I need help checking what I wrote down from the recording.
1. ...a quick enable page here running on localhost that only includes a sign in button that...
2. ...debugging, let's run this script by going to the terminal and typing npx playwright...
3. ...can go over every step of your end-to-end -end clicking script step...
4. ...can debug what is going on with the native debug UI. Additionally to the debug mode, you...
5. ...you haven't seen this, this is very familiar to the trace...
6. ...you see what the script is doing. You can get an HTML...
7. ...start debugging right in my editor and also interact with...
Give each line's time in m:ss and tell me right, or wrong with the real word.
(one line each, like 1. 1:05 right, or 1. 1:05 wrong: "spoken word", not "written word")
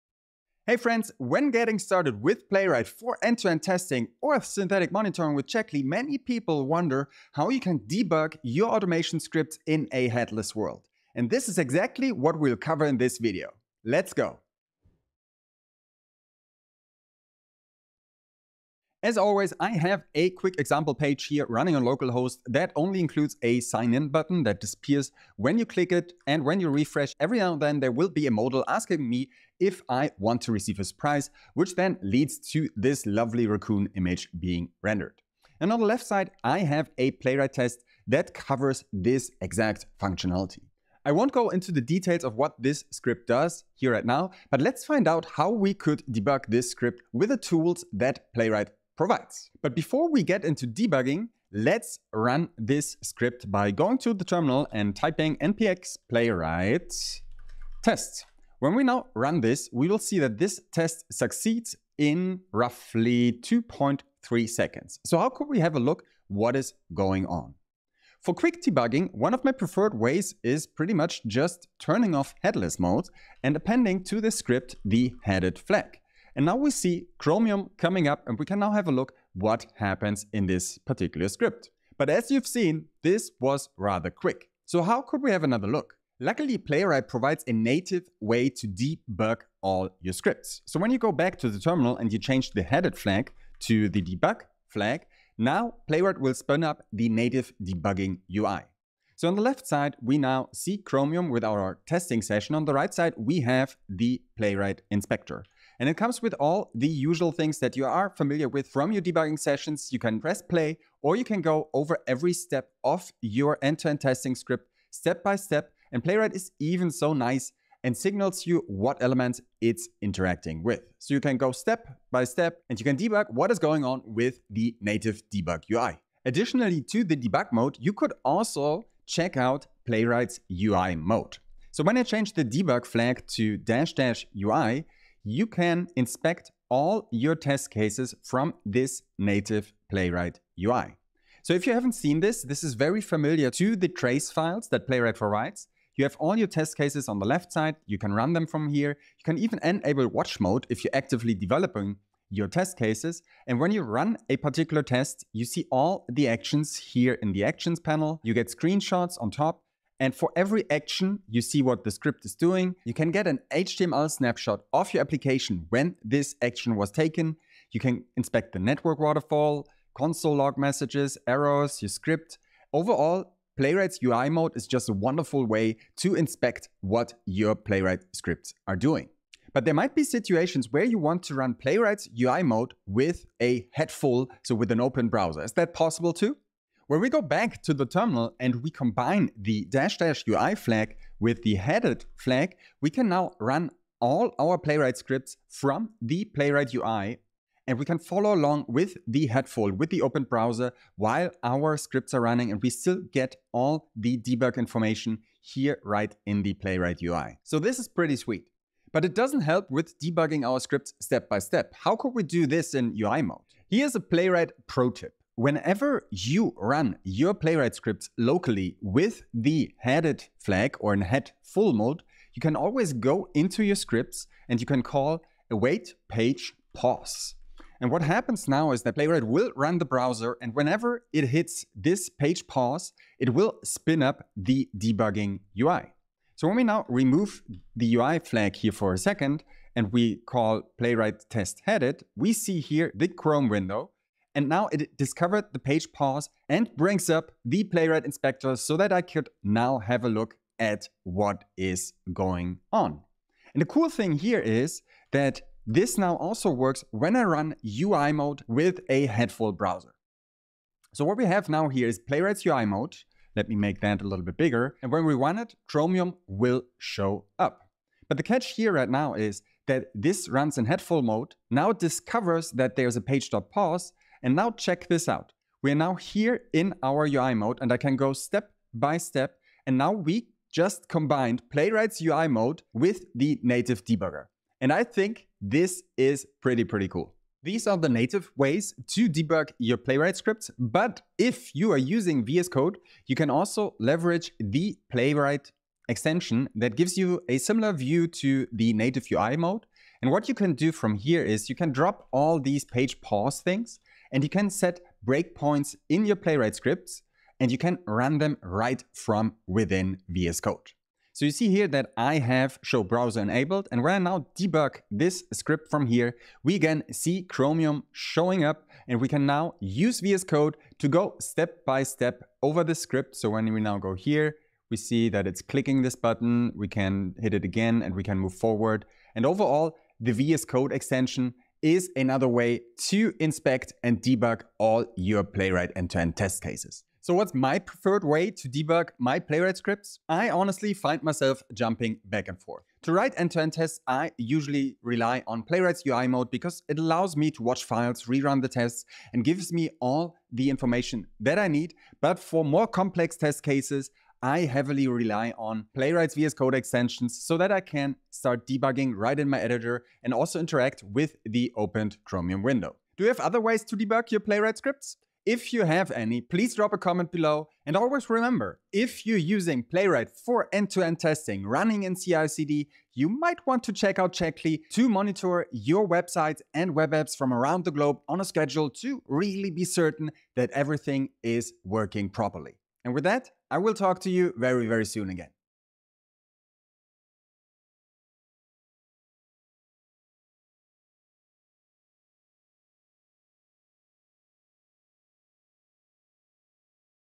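1. 0:20 wrong: "example", not "enable"
2. 0:50 right
3. 1:51 wrong: "testing", not "clicking"
4. 2:02 right
5. 2:21 right
6. 2:41 right
7. 5:58 right.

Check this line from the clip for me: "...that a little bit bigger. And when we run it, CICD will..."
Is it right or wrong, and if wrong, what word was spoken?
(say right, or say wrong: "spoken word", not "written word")
wrong: "Chromium", not "CICD".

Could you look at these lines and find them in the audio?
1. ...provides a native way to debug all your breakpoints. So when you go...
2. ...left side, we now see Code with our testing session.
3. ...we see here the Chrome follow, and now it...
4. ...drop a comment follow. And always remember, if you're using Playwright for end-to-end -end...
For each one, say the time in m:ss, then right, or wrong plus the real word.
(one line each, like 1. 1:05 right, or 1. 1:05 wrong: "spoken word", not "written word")
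1. 1:27 wrong: "scripts", not "breakpoints"
2. 1:39 wrong: "Chromium", not "Code"
3. 4:02 wrong: "window", not "follow"
4. 6:06 wrong: "below", not "follow".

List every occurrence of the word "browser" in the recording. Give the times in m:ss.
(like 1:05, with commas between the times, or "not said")
3:05, 3:20, 3:49, 4:19, 5:12.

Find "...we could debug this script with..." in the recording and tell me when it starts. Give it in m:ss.
0:45.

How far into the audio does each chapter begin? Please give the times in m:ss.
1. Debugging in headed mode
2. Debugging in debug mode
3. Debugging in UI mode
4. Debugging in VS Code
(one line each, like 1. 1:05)
1. 1:08
2. 1:31
3. 2:05
4. 4:50.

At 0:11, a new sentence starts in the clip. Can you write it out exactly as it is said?
And this is exactly what we'll cover in this video.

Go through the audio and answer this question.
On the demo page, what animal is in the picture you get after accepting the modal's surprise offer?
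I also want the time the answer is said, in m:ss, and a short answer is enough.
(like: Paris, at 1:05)
Raccoon, at 0:33.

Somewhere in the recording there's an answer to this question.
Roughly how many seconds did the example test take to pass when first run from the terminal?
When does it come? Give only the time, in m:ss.
1:03.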